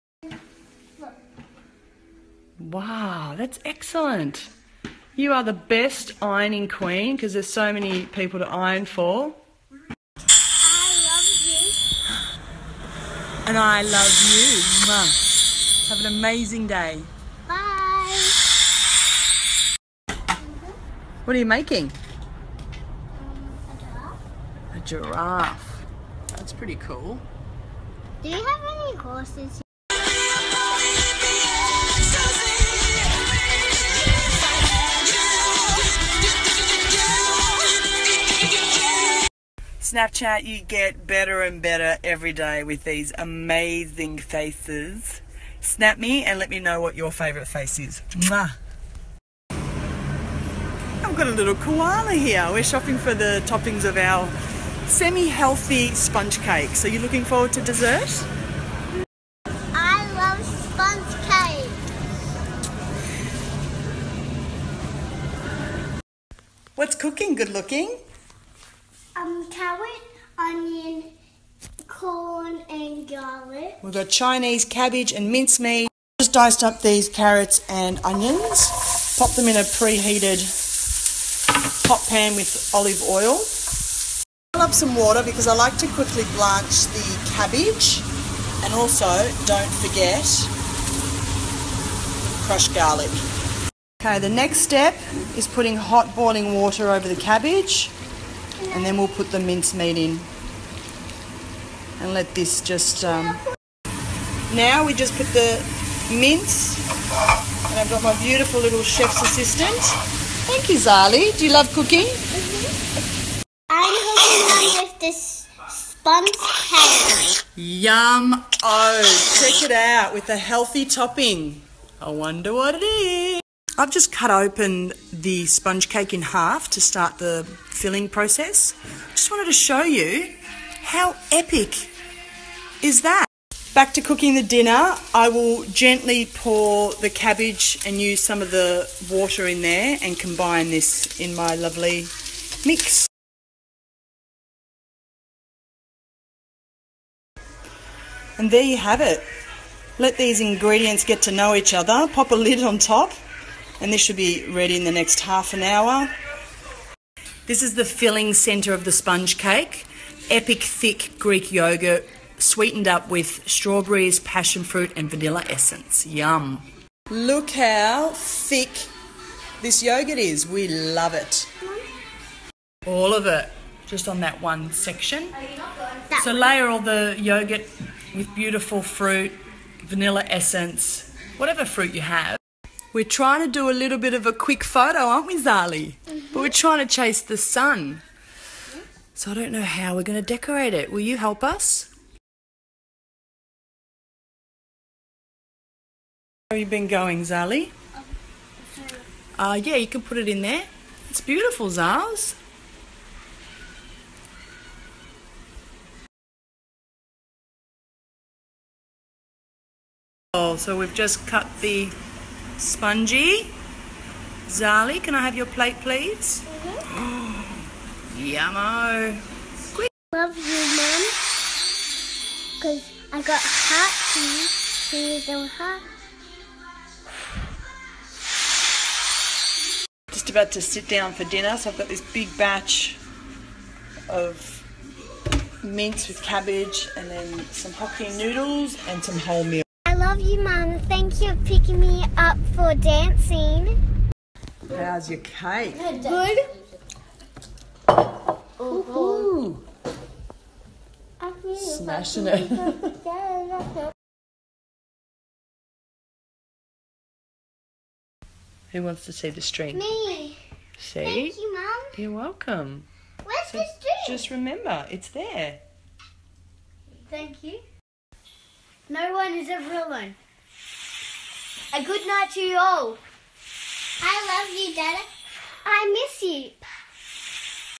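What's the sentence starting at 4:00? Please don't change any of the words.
Thank you for picking me up for dancing.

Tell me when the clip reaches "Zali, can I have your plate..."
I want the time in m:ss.
3:34.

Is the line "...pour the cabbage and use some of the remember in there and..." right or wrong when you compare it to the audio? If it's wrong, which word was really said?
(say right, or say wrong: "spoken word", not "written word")
wrong: "water", not "remember".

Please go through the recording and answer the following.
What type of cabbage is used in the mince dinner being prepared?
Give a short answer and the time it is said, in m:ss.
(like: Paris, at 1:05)
Chinese cabbage, at 1:14.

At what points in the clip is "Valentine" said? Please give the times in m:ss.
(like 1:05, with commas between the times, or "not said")
not said.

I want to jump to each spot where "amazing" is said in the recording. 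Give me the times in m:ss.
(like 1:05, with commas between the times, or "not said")
0:16, 0:43.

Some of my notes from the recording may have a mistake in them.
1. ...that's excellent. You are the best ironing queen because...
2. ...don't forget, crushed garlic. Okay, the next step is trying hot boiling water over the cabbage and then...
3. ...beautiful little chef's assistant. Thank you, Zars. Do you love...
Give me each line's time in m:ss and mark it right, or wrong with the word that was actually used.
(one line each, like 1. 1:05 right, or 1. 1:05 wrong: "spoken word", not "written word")
1. 0:03 right
2. 1:29 wrong: "putting", not "trying"
3. 1:48 wrong: "Zali", not "Zars".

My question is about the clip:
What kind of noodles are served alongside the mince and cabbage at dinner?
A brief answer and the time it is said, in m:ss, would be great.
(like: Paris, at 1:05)
Hokkien noodles, at 3:57.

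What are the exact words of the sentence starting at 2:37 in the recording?
This is the filling centre of the sponge cake.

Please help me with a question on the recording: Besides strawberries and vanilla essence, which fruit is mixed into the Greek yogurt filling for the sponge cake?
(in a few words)
Passion fruit.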